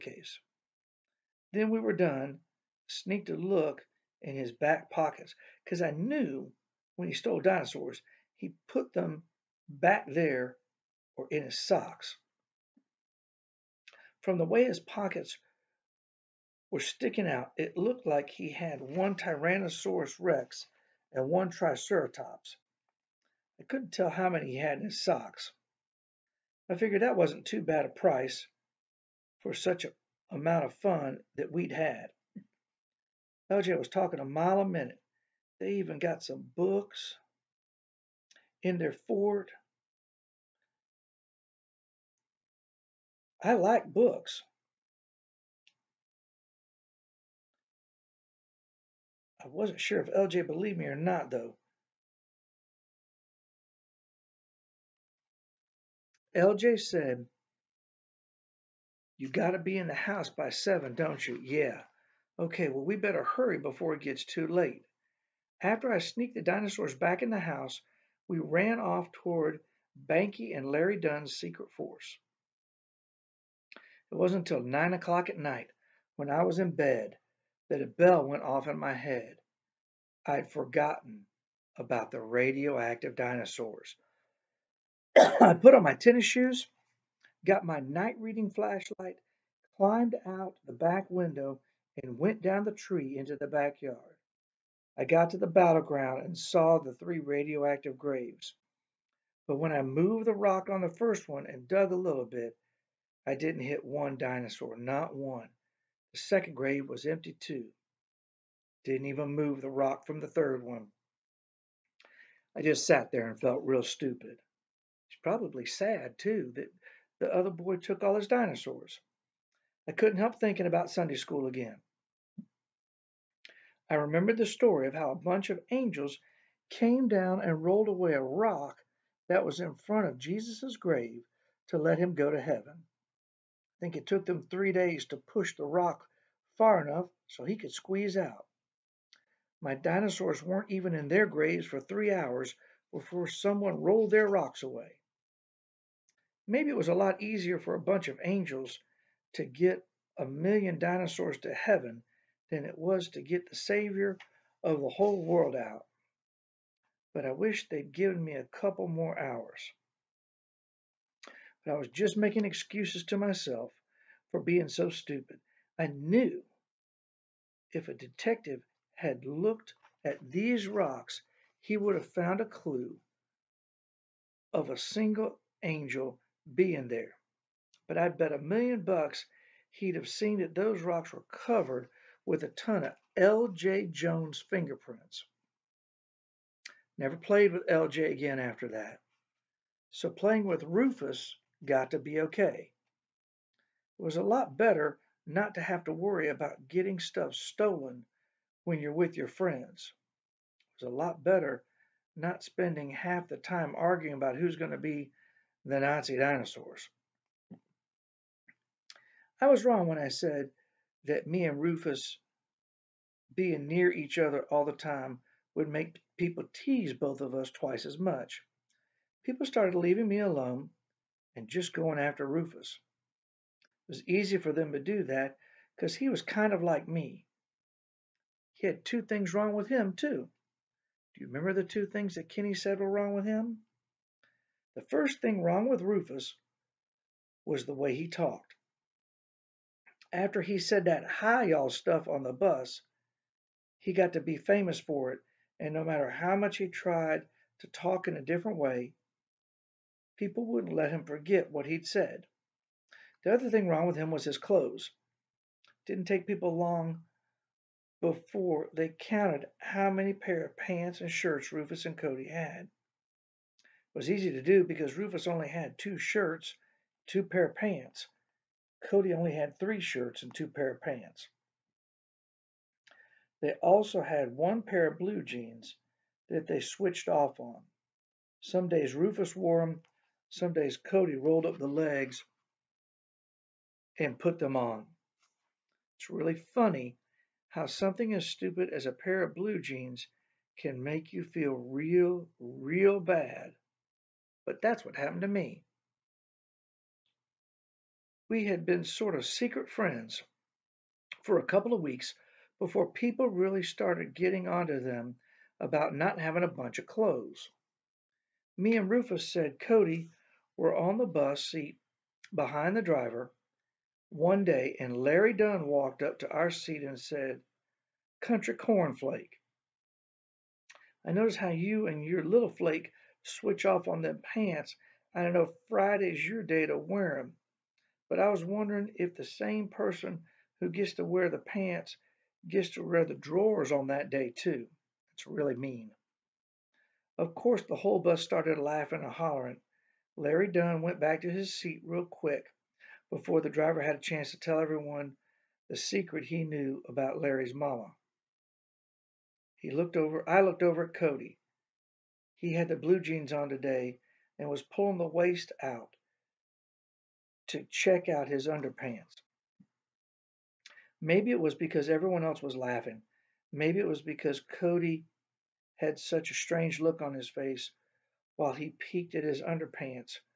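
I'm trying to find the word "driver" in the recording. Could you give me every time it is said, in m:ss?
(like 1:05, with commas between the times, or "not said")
5:12, 5:43.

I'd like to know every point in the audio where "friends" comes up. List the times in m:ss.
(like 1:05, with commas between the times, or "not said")
3:19, 4:59.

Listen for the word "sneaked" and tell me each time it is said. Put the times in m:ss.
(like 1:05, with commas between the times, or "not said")
0:02, 1:05.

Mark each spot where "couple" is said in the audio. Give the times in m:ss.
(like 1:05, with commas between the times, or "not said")
2:38, 5:01.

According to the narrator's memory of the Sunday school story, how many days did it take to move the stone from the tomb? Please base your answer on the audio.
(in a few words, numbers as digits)
3.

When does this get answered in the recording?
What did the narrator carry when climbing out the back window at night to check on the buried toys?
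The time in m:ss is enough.
1:27.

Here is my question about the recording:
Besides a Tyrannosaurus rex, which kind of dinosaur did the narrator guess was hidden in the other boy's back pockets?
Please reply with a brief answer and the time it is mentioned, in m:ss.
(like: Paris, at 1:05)
Triceratops, at 0:21.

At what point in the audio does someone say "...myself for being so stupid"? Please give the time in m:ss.
2:43.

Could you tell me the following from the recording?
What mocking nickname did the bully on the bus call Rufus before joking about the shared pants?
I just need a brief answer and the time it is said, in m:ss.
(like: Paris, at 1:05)
Country cornflake, at 5:18.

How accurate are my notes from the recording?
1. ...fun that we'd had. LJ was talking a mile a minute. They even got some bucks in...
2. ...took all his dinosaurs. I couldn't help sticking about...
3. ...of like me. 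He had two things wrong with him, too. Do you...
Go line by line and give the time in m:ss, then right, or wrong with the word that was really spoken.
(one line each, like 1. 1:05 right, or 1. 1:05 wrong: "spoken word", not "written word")
1. 0:30 wrong: "books", not "bucks"
2. 1:57 wrong: "thinking", not "sticking"
3. 3:46 right.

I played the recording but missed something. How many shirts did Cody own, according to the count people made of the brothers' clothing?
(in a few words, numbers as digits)
3.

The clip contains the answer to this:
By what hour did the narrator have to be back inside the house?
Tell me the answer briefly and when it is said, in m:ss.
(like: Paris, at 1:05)
7, at 1:00.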